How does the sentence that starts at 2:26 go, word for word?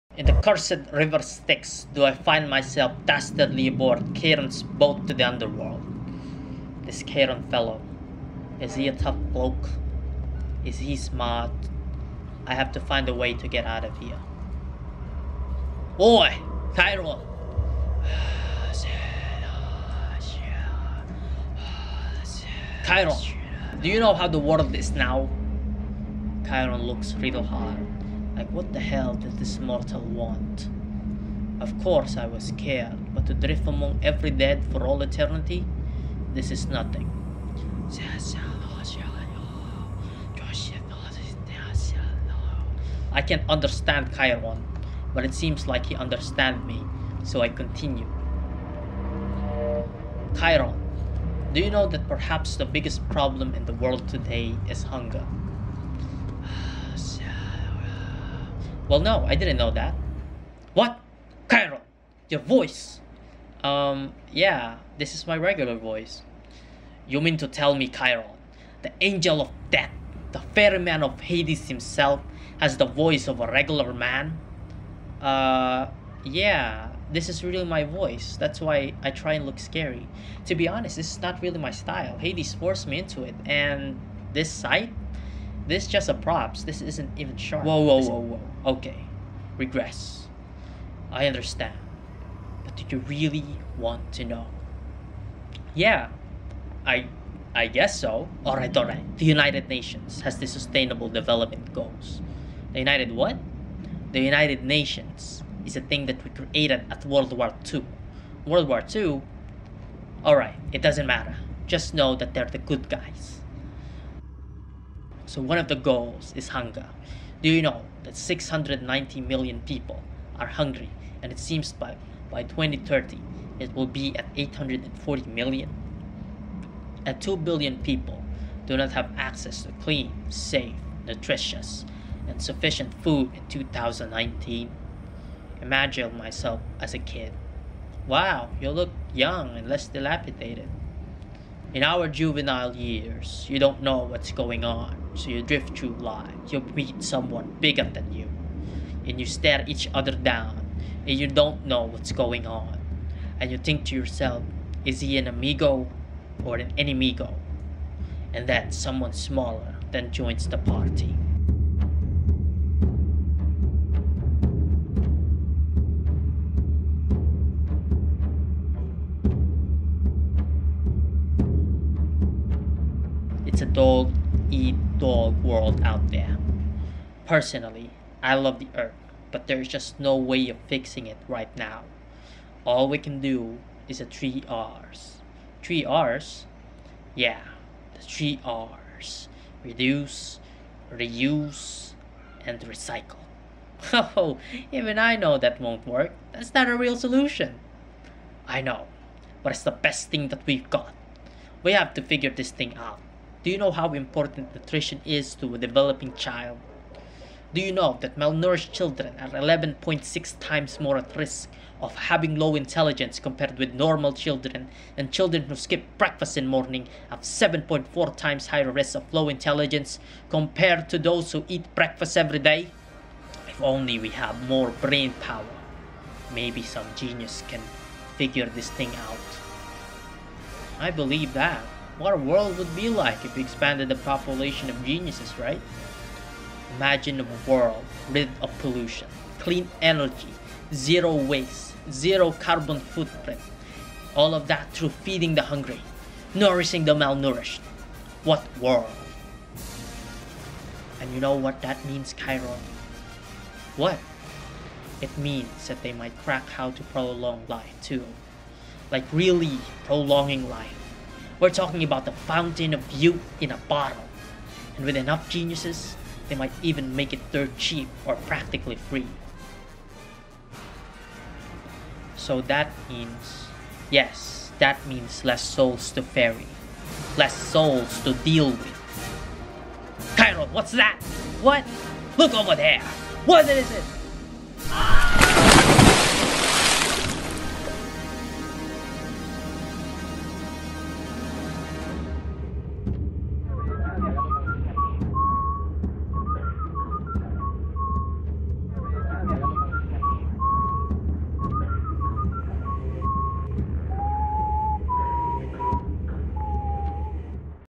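You meet someone bigger than you, and you stare each other down, and you don't know what's going on.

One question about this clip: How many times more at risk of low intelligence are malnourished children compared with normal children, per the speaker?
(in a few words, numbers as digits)
11.6 times.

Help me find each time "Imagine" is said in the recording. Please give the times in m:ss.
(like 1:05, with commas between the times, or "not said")
2:15, 3:56.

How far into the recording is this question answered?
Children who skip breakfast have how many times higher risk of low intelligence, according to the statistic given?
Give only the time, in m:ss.
3:37.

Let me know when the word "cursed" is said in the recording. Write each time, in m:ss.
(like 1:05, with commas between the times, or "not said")
0:00.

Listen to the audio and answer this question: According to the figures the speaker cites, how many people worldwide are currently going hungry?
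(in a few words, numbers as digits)
690 million.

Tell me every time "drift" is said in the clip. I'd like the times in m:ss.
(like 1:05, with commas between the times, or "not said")
0:33, 2:25.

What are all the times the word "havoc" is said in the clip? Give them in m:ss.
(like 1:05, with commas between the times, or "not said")
not said.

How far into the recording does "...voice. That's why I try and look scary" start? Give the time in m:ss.
1:17.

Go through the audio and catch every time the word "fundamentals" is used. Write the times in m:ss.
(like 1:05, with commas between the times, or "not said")
not said.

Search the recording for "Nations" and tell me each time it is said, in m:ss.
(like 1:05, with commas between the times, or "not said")
1:39, 1:44.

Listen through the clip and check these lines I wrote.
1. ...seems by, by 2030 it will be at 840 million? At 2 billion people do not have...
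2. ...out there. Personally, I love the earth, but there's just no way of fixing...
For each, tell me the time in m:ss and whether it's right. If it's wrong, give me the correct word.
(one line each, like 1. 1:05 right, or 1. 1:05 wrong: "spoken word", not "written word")
1. 2:01 right
2. 2:55 right.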